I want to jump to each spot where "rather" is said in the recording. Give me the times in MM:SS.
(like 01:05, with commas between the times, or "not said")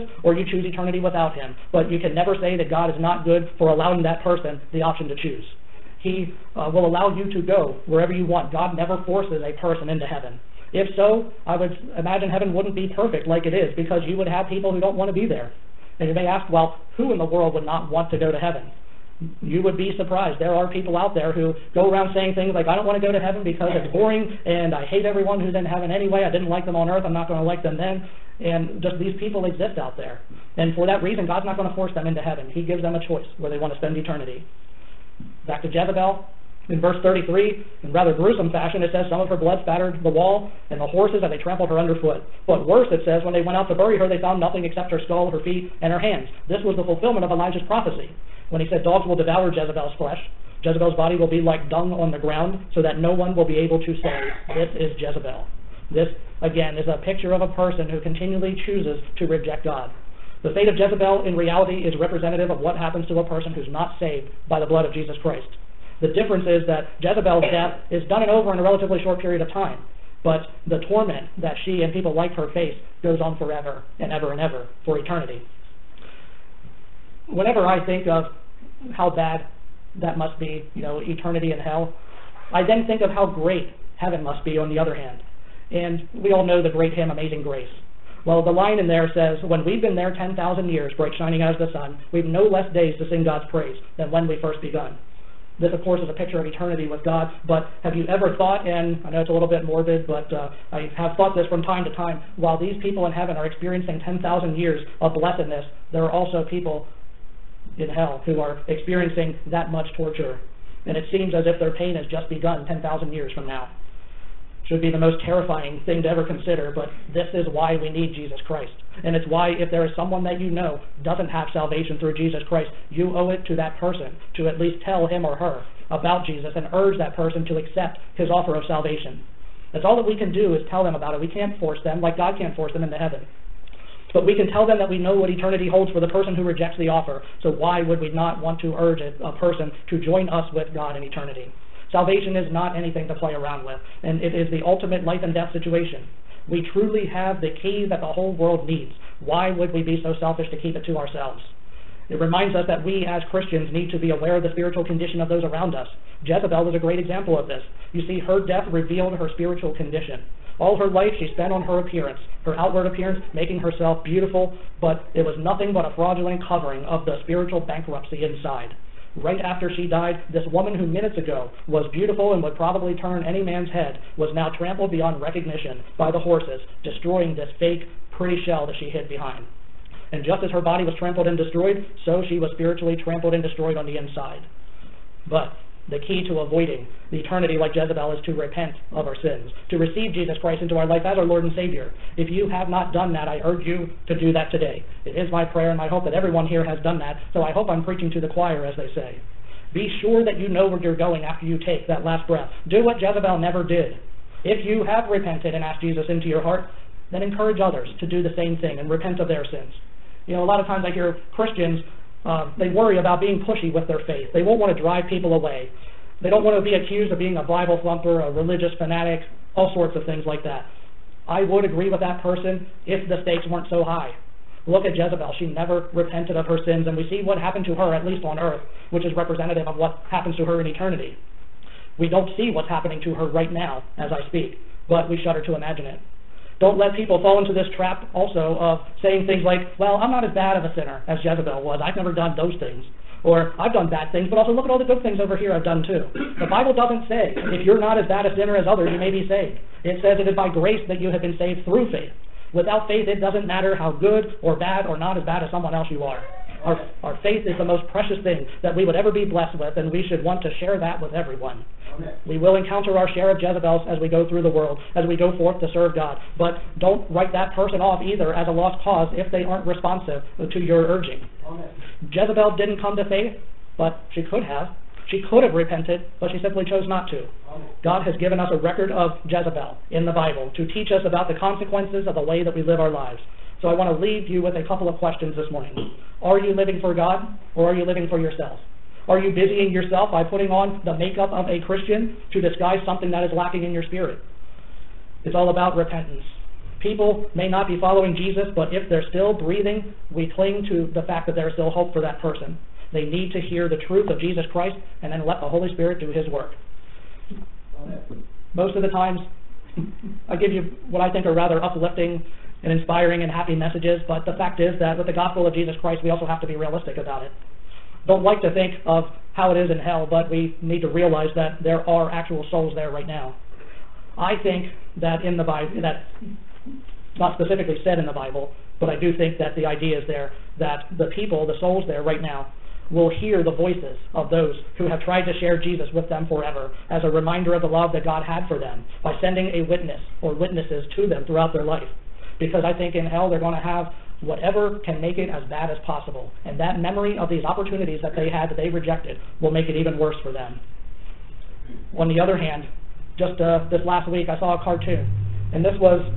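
00:37, 05:11.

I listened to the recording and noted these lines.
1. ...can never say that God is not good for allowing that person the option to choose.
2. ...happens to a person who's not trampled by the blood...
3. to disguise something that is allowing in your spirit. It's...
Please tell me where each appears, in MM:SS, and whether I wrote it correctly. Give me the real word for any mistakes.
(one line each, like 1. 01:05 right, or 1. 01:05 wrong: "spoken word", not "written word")
1. 00:02 right
2. 01:02 wrong: "saved", not "trampled"
3. 04:52 wrong: "lacking", not "allowing".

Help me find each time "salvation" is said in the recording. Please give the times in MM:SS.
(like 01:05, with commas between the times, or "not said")
02:01, 02:08, 02:21.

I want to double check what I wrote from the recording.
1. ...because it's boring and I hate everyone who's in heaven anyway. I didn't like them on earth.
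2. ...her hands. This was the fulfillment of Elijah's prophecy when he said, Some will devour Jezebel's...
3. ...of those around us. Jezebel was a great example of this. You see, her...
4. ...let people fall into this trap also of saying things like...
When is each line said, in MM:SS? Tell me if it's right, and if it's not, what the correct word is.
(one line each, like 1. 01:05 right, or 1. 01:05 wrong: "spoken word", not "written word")
1. 00:23 right
2. 00:45 wrong: "Dogs", not "Some"
3. 02:35 right
4. 03:56 right.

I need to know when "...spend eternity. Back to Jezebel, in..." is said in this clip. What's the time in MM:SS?
00:33.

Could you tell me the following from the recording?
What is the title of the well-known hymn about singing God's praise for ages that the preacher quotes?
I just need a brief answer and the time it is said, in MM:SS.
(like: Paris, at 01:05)
Amazing Grace, at 01:27.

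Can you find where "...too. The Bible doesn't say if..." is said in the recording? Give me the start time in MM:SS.
04:05.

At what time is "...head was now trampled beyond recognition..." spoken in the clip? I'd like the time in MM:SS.
02:53.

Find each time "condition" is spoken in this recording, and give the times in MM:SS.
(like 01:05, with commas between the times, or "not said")
02:34, 02:39.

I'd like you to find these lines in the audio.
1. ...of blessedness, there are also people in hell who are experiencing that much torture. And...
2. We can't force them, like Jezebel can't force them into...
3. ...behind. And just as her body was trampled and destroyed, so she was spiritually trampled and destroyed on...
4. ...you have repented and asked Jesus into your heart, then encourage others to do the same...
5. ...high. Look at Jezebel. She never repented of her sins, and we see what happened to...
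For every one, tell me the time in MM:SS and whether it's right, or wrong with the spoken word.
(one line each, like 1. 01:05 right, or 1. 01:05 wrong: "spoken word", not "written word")
1. 01:45 right
2. 02:11 wrong: "God", not "Jezebel"
3. 02:59 right
4. 03:24 right
5. 03:43 right.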